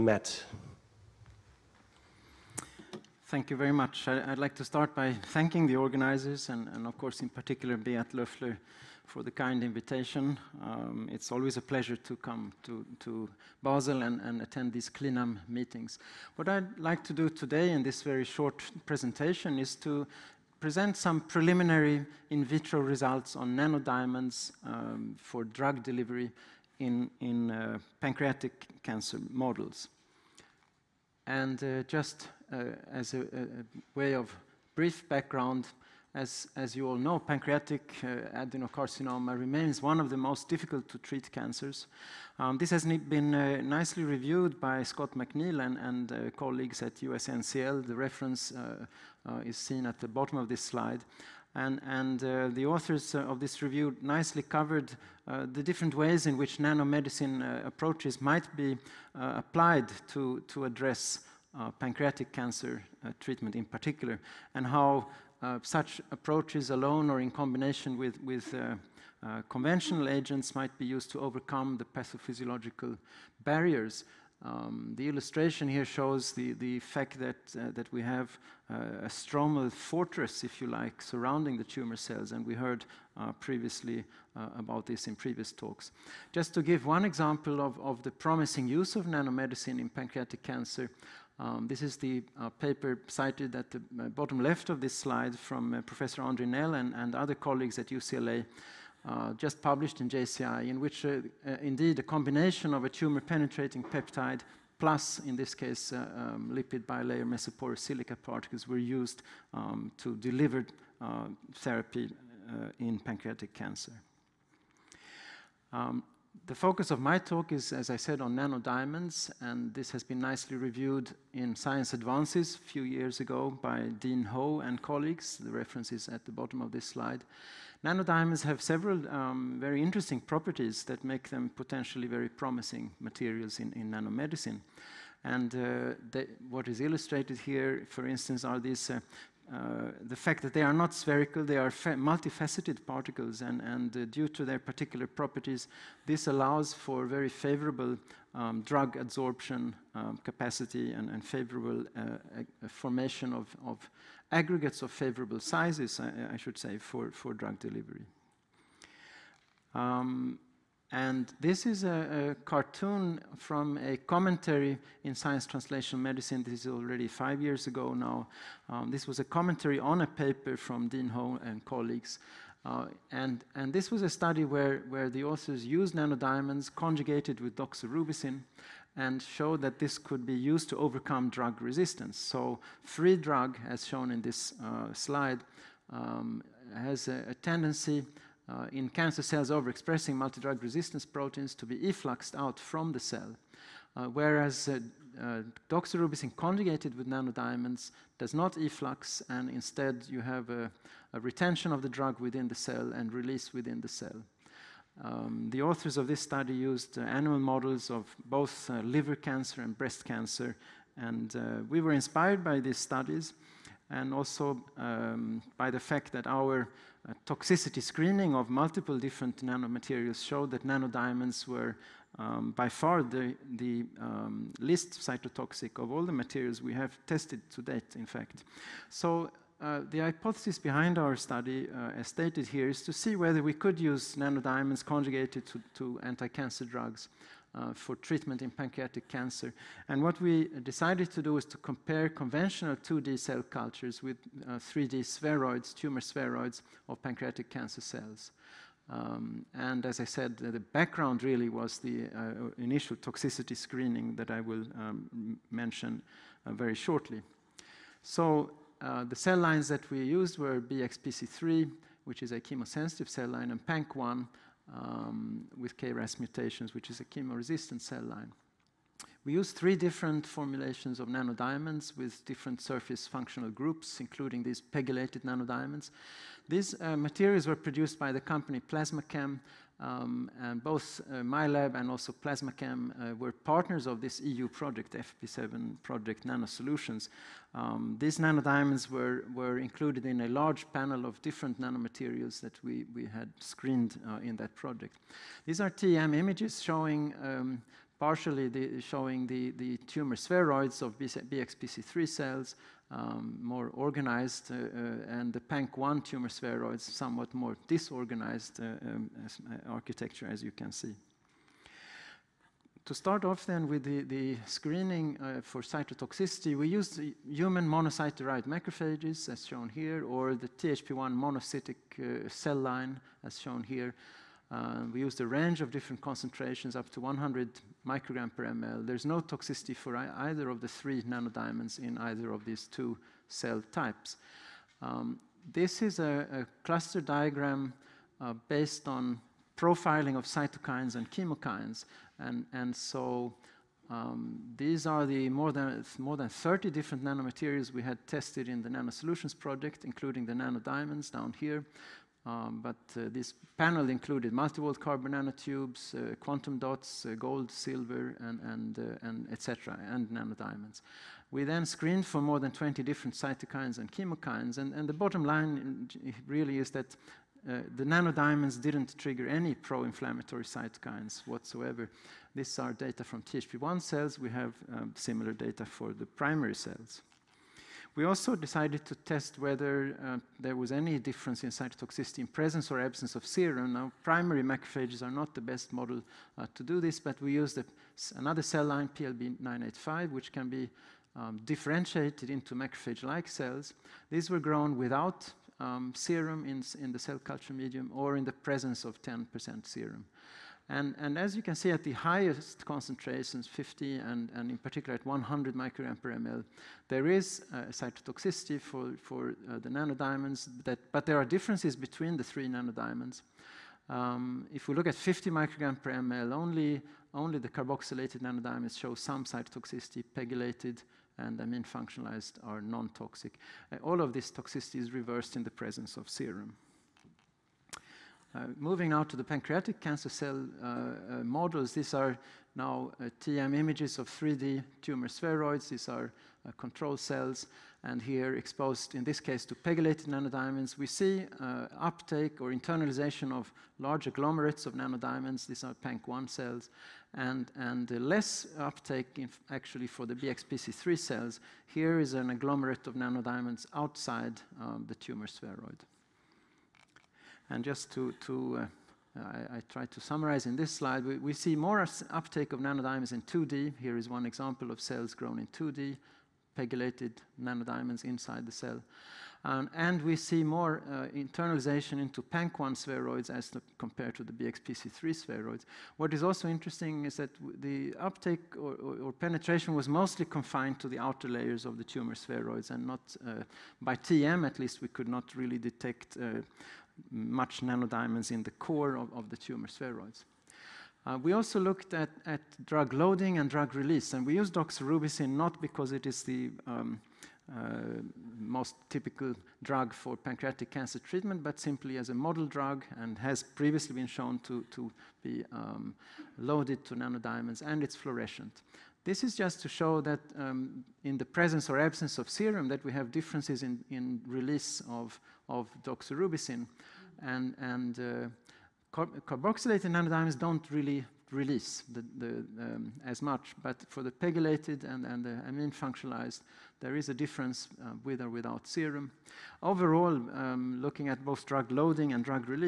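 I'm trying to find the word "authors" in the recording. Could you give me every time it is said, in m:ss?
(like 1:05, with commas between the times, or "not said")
0:52, 2:55, 3:25.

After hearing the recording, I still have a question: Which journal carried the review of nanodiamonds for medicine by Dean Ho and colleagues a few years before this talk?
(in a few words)
Science Advances.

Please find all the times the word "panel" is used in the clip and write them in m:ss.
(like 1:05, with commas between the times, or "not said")
4:50, 5:53.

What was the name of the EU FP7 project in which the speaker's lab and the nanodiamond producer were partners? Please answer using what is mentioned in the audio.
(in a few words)
Nanosolutions.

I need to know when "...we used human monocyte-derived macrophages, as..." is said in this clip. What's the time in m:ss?
5:16.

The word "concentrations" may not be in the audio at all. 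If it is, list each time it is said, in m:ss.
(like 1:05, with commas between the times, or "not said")
5:26, 6:42.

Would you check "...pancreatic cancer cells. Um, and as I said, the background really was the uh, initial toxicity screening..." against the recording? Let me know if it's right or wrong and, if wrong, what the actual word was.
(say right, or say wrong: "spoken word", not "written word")
right.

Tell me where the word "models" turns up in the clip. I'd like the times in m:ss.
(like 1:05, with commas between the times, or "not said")
0:29, 3:27, 6:25, 7:11, 8:22.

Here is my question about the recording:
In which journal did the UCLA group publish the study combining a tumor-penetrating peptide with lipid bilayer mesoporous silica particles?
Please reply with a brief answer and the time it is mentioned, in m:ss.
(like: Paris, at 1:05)
JCI, at 1:40.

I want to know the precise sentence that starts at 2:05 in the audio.
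The reference is at the bottom of this slide.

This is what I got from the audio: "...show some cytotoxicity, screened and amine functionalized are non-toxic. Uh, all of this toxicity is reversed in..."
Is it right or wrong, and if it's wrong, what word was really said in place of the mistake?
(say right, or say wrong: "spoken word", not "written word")
wrong: "pegylated", not "screened".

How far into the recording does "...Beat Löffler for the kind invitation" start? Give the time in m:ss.
0:07.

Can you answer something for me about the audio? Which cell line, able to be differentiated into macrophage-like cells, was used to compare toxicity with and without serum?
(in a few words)
PLB985.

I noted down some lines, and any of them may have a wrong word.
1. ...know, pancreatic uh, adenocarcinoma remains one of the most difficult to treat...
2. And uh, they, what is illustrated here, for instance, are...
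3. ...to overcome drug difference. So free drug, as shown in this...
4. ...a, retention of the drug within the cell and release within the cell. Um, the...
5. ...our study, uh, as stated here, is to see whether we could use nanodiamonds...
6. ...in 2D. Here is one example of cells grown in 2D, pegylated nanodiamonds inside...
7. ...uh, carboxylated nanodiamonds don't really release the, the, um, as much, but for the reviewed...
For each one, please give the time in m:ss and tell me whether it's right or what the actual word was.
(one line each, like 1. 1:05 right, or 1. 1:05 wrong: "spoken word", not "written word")
1. 0:36 right
2. 2:15 right
3. 3:00 wrong: "resistance", not "difference"
4. 3:21 right
5. 3:50 right
6. 7:43 right
7. 8:37 wrong: "pegylated", not "reviewed".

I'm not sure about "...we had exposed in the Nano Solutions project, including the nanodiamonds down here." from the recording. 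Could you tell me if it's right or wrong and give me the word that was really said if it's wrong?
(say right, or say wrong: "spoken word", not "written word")
wrong: "tested", not "exposed".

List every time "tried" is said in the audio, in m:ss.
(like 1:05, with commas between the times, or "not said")
7:39.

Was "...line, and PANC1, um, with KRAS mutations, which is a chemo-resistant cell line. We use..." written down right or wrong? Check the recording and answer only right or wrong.
right.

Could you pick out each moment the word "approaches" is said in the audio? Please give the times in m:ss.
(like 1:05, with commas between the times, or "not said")
0:57, 1:06.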